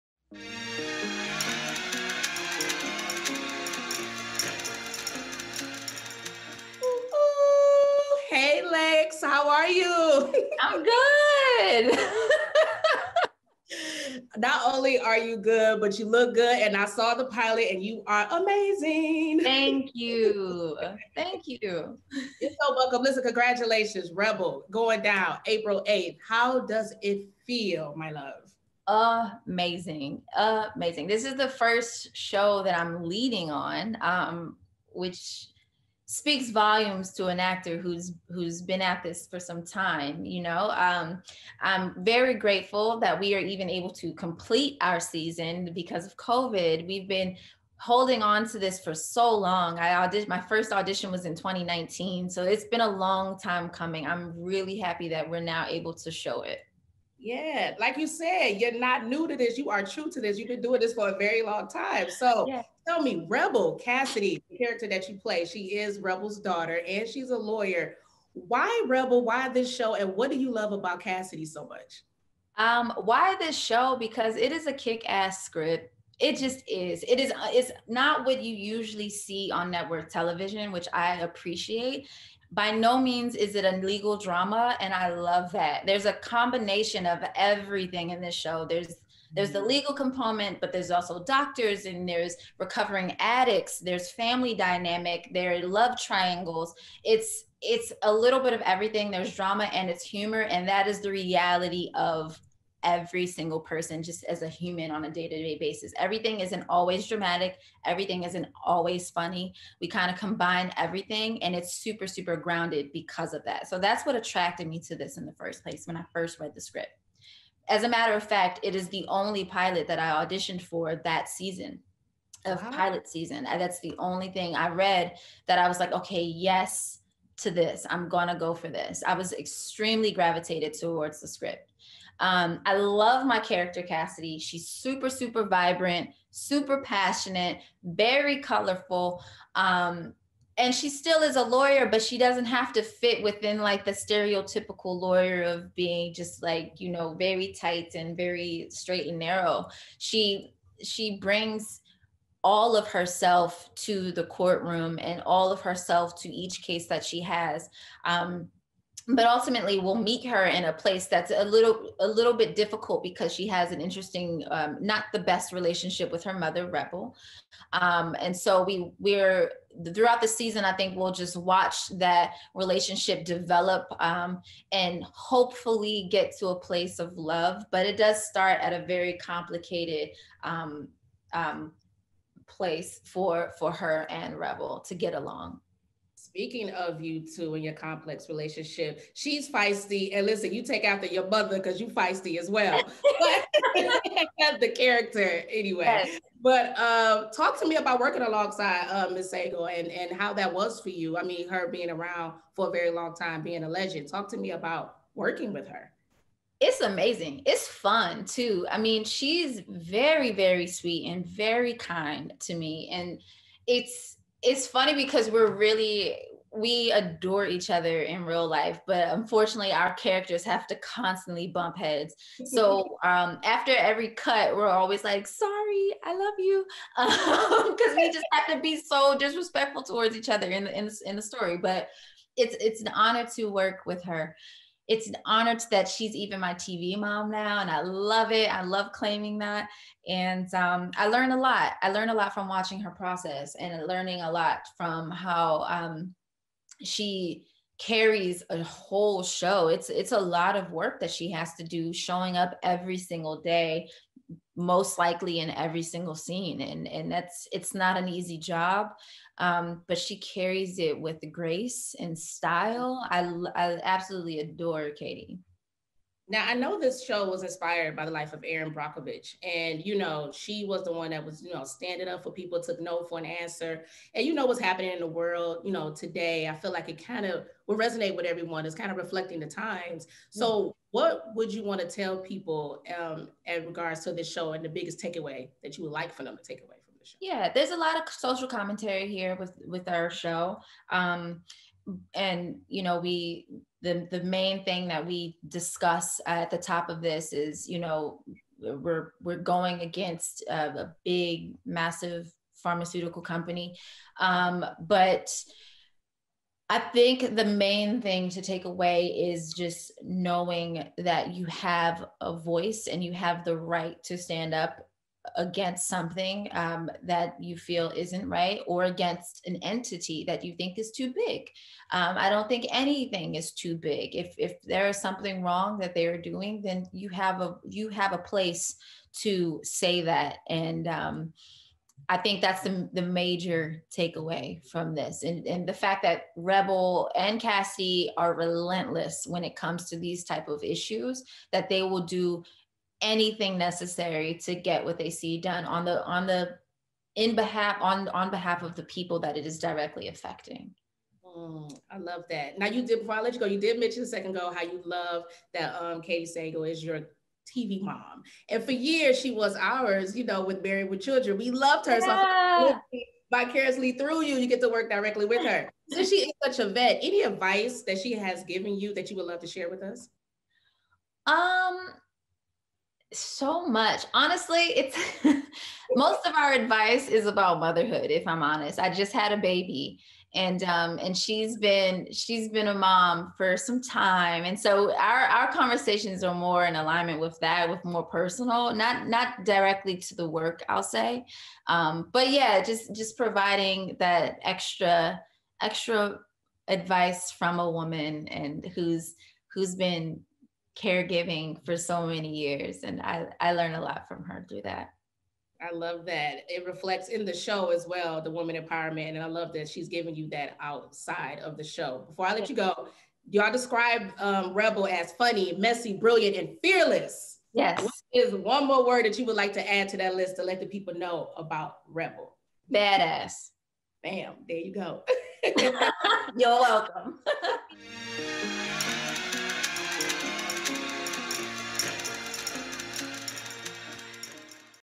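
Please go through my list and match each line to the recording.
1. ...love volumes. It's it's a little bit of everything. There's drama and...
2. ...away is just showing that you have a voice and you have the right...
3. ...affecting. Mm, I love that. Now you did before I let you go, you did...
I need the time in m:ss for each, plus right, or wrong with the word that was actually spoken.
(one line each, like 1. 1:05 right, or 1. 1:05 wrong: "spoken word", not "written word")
1. 1:35 wrong: "triangles", not "volumes"
2. 5:08 wrong: "knowing", not "showing"
3. 5:50 right.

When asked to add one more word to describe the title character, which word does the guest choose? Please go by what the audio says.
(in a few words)
Badass.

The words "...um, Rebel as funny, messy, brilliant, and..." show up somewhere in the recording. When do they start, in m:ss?
6:54.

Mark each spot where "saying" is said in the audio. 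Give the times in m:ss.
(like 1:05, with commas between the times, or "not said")
not said.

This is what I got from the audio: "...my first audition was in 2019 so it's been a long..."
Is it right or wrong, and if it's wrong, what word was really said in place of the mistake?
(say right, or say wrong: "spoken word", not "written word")
right.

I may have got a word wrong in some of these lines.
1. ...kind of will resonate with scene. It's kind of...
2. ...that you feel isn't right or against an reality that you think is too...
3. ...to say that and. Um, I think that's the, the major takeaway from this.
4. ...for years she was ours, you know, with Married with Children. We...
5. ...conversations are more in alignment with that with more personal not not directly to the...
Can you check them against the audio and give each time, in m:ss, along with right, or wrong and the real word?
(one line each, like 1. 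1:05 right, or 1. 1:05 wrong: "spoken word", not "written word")
1. 4:37 wrong: "everyone", not "scene"
2. 5:17 wrong: "entity", not "reality"
3. 5:29 right
4. 5:58 right
5. 6:25 right.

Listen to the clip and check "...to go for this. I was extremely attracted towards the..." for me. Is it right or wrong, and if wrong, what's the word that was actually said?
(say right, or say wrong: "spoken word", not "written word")
wrong: "gravitated", not "attracted".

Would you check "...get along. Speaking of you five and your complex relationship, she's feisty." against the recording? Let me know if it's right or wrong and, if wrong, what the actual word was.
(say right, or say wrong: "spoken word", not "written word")
wrong: "two", not "five".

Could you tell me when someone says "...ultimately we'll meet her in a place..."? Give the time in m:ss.
2:39.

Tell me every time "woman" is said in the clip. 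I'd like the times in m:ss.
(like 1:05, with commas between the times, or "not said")
6:37, 6:48.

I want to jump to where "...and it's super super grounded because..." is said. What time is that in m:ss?
1:51.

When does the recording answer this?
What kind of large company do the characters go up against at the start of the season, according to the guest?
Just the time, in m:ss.
5:02.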